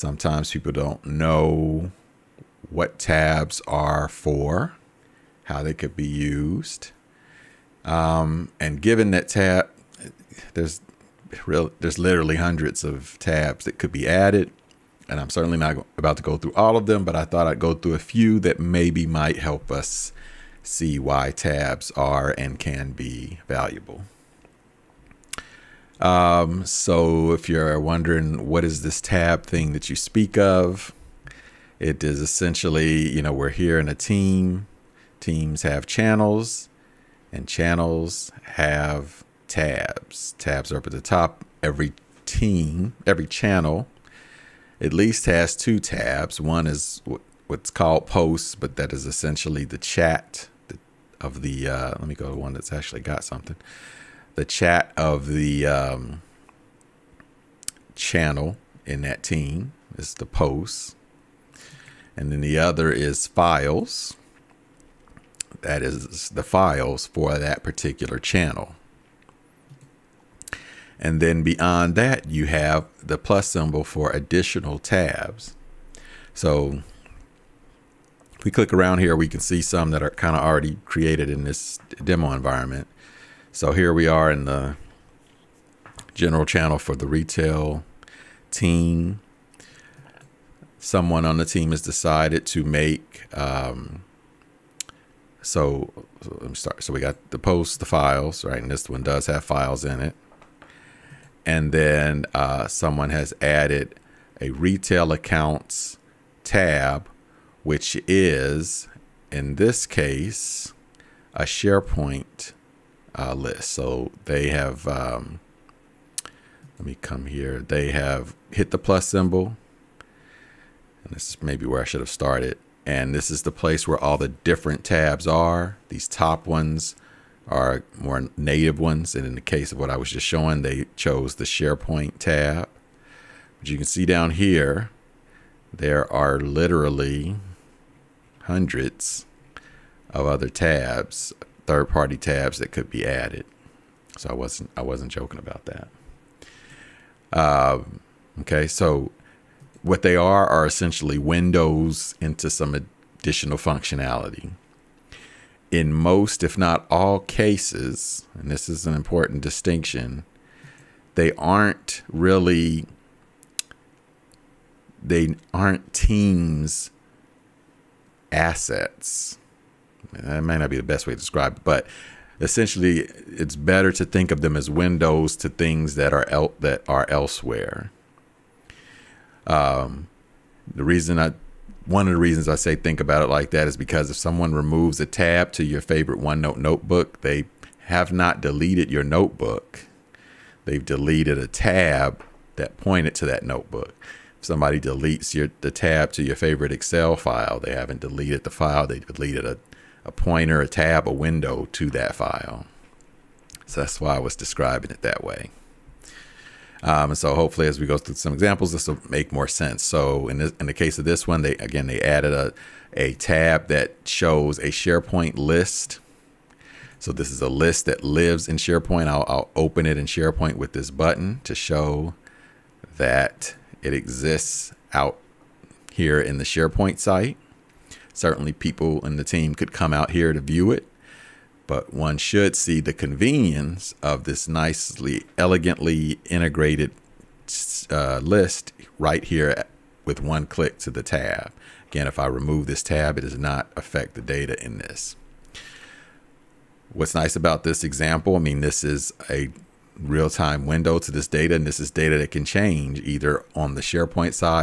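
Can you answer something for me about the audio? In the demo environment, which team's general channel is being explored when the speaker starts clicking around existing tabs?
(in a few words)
Retail team.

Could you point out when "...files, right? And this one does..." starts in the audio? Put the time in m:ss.
1:37.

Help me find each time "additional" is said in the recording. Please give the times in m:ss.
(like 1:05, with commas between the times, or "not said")
1:14, 2:32.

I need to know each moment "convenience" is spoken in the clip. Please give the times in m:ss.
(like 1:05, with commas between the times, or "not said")
3:52.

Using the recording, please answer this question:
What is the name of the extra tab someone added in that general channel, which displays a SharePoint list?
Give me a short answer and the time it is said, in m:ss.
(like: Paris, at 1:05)
Retail accounts, at 1:44.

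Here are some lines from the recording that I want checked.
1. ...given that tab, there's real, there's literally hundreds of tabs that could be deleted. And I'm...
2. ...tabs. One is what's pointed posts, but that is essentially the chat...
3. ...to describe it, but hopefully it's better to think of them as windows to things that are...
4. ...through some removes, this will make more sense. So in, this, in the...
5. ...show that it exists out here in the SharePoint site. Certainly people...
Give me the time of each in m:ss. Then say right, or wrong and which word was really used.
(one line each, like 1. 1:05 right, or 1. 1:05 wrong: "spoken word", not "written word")
1. 0:08 wrong: "added", not "deleted"
2. 0:45 wrong: "called", not "pointed"
3. 2:51 wrong: "essentially", not "hopefully"
4. 3:27 wrong: "examples", not "removes"
5. 3:41 right.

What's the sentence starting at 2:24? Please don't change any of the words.
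So I wasn't I wasn't joking about that.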